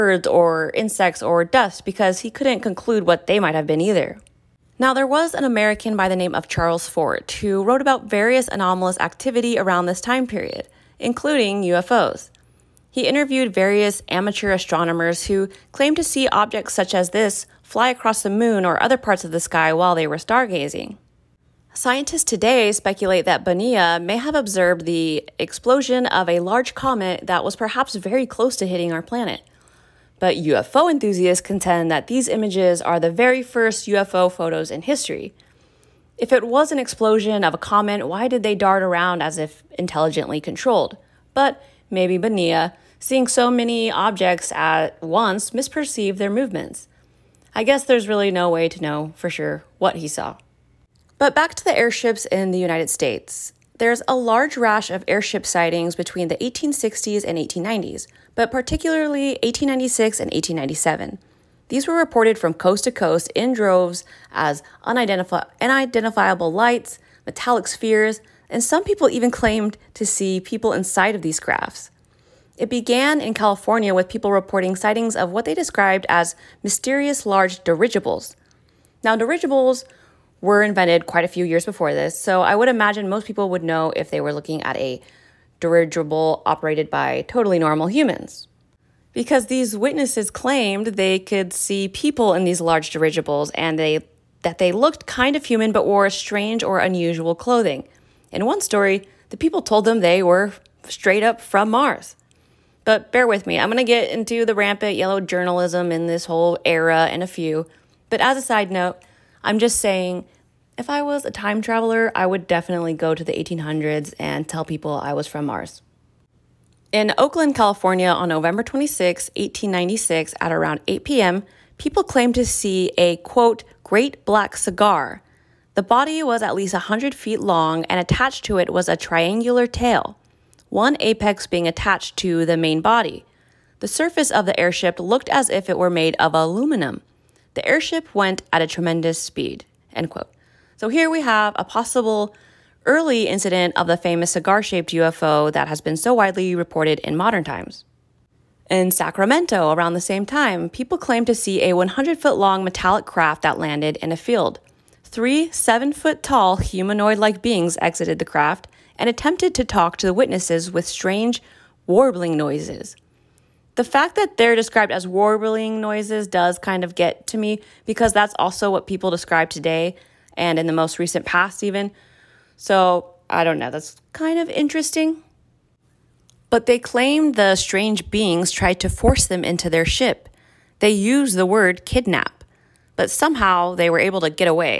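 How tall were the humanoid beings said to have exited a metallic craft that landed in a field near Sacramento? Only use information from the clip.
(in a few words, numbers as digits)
7 feet.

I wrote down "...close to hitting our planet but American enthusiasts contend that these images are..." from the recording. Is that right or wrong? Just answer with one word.
wrong.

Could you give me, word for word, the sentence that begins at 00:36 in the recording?
If it was an explosion of a comet, why did they dart around as if intelligently controlled?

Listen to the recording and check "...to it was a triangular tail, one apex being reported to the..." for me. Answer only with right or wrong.
wrong.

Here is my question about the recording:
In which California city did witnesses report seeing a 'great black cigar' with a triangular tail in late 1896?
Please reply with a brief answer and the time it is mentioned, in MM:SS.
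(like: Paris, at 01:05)
Oakland, at 01:57.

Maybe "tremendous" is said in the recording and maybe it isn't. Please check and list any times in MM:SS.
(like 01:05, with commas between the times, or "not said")
02:18.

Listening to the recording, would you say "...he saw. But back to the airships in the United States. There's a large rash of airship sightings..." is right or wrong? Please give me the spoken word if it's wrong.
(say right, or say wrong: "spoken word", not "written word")
right.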